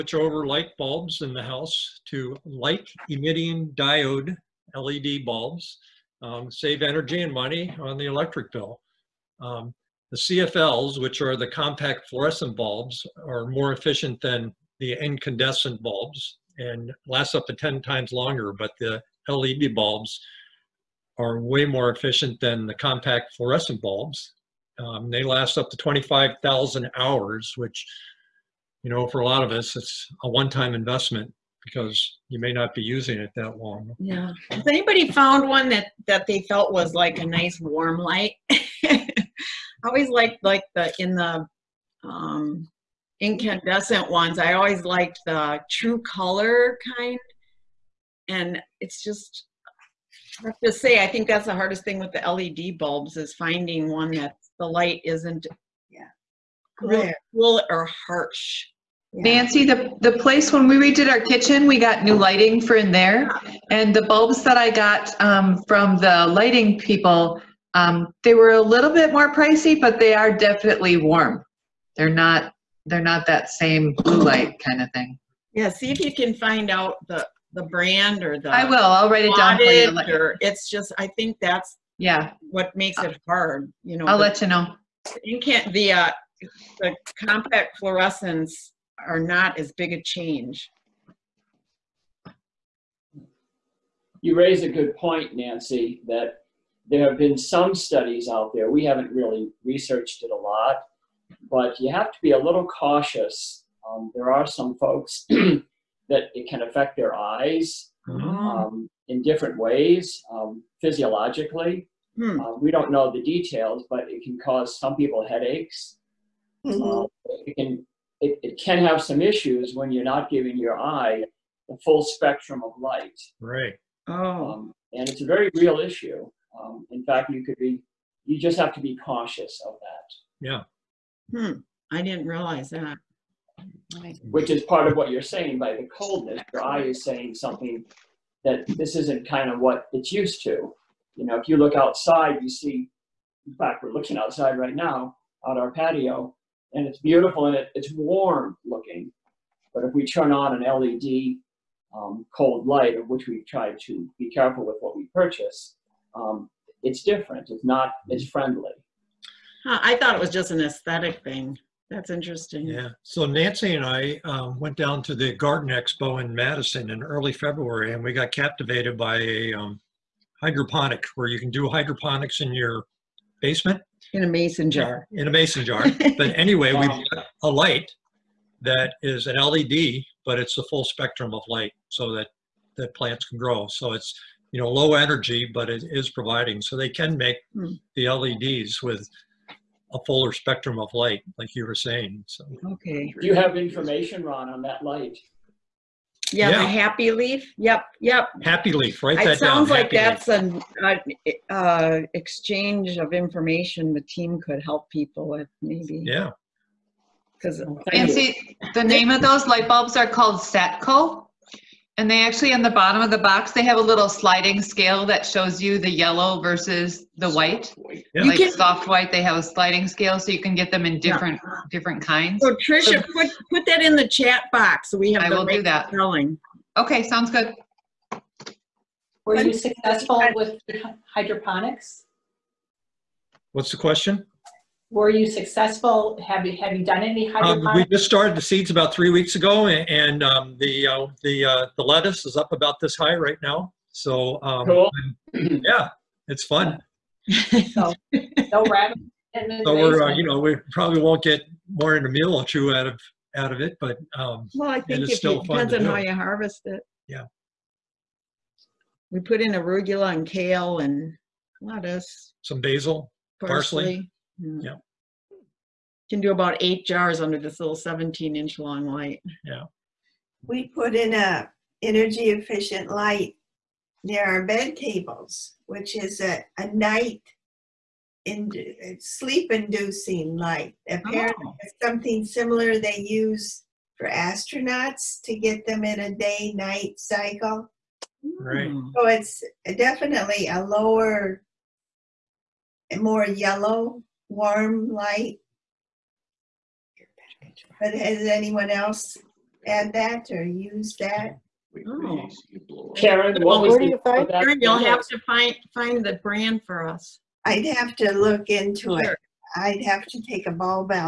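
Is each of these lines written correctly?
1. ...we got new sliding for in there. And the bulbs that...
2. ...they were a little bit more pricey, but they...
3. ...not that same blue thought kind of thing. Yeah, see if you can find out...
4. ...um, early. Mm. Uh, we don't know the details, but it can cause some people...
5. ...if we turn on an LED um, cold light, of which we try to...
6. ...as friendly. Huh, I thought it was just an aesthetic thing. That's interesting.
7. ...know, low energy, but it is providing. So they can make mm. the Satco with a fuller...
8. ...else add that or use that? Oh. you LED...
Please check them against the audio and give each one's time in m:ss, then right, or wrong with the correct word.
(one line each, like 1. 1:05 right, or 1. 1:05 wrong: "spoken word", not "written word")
1. 1:01 wrong: "lighting", not "sliding"
2. 1:08 right
3. 1:13 wrong: "light", not "thought"
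4. 1:50 wrong: "physiologically", not "early"
5. 2:29 right
6. 2:38 right
7. 3:04 wrong: "LEDs", not "Satco"
8. 4:58 wrong: "Karen", not "LED".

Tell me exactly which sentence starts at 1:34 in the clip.
You raise a good point, Nancy, that there have been some studies out there.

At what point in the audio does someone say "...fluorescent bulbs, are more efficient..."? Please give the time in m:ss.
0:12.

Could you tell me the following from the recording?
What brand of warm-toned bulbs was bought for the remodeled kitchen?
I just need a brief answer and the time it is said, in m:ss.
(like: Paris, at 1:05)
Satco, at 3:30.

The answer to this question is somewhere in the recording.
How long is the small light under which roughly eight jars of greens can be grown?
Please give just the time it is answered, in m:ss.
4:27.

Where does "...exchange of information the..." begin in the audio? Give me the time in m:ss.
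3:22.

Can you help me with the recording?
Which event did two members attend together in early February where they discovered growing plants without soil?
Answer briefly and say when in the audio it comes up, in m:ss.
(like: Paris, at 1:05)
Garden Expo, at 2:45.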